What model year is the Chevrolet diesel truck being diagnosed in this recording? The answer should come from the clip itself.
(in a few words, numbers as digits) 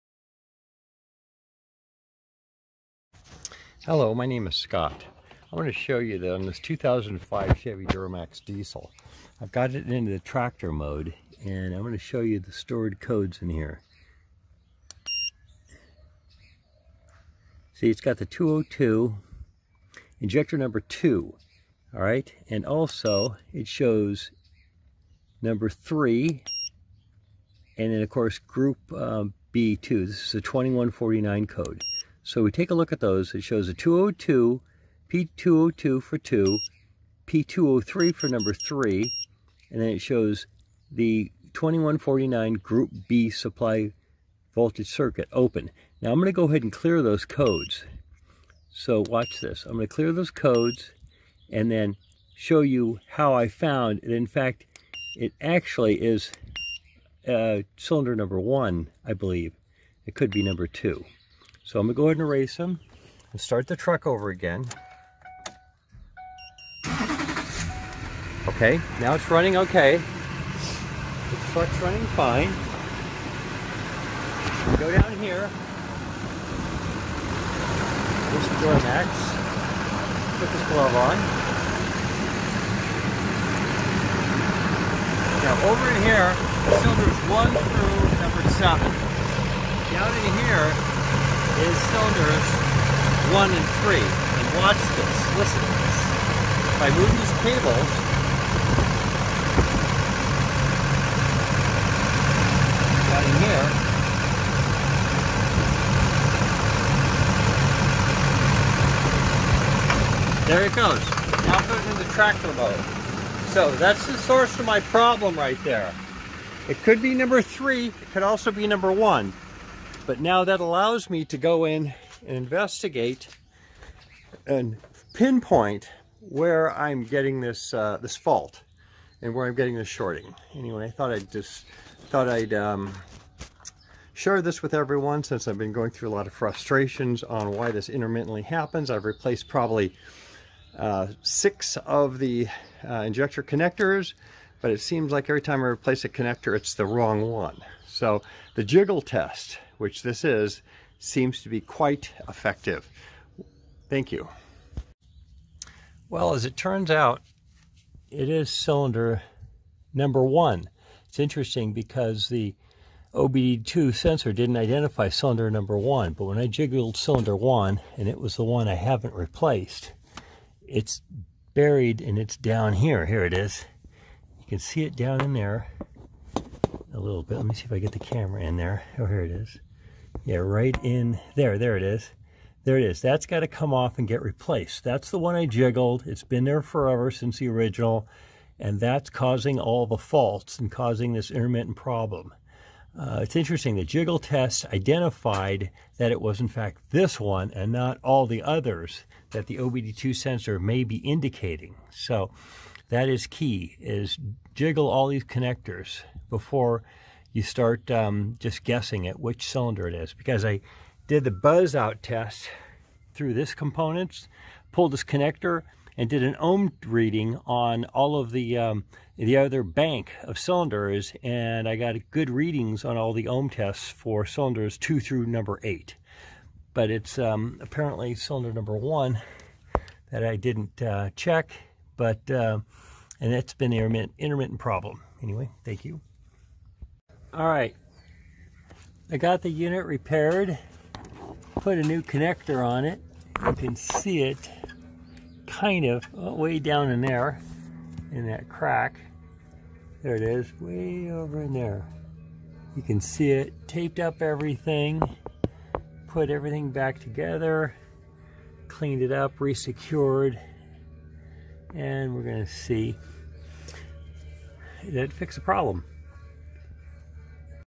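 2005.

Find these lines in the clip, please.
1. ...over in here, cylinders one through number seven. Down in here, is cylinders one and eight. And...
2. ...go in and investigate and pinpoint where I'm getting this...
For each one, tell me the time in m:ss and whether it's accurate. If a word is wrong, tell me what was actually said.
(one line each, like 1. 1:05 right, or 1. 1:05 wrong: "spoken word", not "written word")
1. 1:25 wrong: "three", not "eight"
2. 2:01 right.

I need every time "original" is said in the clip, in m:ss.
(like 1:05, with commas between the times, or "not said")
3:07.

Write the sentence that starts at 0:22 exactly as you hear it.
And also, it shows number 3, and then, of course, group um, uh, B2.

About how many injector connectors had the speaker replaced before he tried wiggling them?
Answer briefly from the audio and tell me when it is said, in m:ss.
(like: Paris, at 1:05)
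6, at 2:21.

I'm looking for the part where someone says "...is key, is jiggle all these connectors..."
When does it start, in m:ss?
3:23.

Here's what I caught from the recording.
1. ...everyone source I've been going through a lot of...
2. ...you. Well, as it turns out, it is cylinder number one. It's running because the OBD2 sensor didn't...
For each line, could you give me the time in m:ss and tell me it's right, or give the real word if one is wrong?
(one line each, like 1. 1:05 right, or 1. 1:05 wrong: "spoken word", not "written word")
1. 2:14 wrong: "since", not "source"
2. 2:34 wrong: "interesting", not "running".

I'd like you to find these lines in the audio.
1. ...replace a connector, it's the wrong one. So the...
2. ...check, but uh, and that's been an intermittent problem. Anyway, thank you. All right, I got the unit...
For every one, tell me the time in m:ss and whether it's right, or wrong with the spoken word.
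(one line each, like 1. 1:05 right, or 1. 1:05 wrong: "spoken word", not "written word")
1. 2:25 right
2. 3:51 right.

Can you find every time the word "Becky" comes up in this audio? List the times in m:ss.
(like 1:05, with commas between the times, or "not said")
not said.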